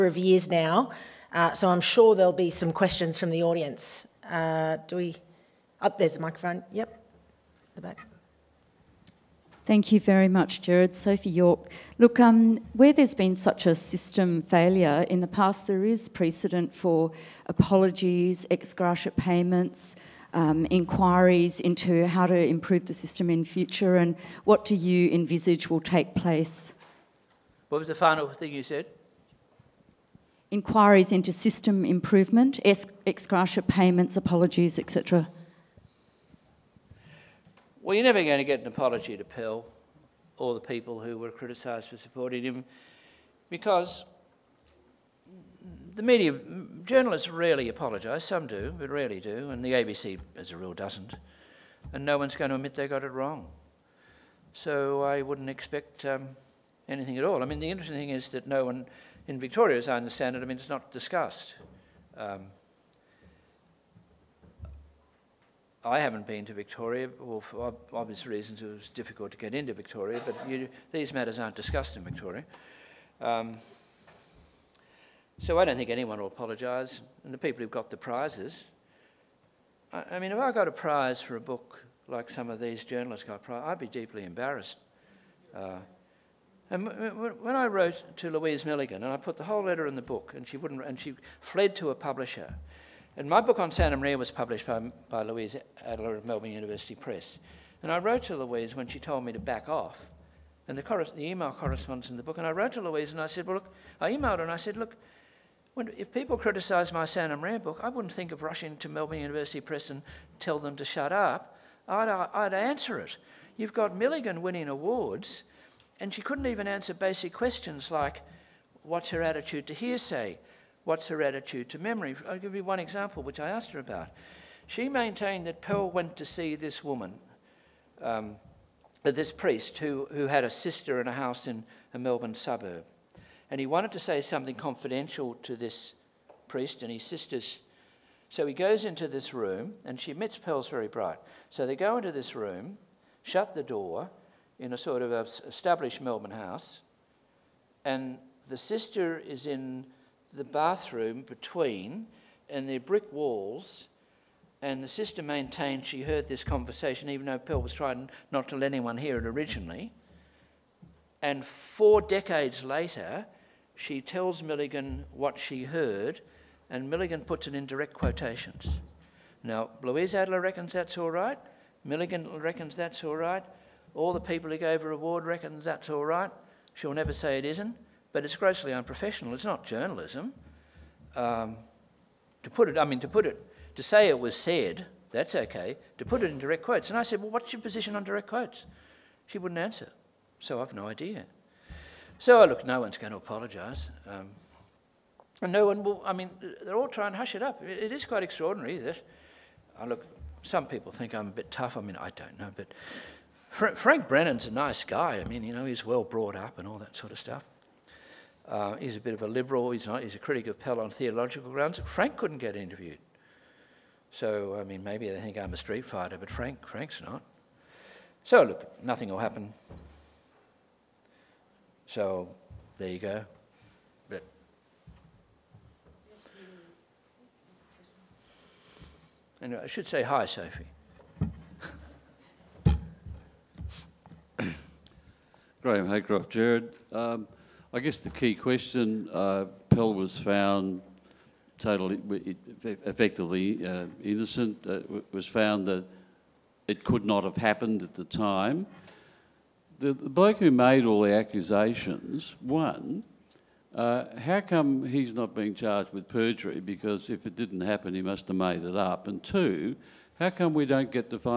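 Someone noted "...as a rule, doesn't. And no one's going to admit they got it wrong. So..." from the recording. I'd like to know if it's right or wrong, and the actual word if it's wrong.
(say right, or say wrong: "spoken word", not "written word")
right.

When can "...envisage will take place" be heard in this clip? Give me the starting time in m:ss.
0:25.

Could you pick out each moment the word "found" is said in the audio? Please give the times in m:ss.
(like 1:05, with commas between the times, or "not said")
4:00, 4:05.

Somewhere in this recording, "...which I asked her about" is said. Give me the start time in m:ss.
2:03.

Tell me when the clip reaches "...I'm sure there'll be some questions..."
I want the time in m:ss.
0:01.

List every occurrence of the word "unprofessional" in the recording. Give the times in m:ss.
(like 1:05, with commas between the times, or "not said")
2:58.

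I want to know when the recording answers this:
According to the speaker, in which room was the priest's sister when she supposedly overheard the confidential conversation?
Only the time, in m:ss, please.
2:30.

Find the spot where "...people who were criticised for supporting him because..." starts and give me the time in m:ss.
0:40.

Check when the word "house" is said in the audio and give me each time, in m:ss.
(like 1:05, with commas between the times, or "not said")
2:11, 2:26.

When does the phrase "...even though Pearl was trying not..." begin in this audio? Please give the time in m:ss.
2:37.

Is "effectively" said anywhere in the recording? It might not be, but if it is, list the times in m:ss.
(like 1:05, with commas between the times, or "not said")
4:02.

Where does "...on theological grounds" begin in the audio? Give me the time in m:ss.
3:30.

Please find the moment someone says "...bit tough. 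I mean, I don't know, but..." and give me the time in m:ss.
3:21.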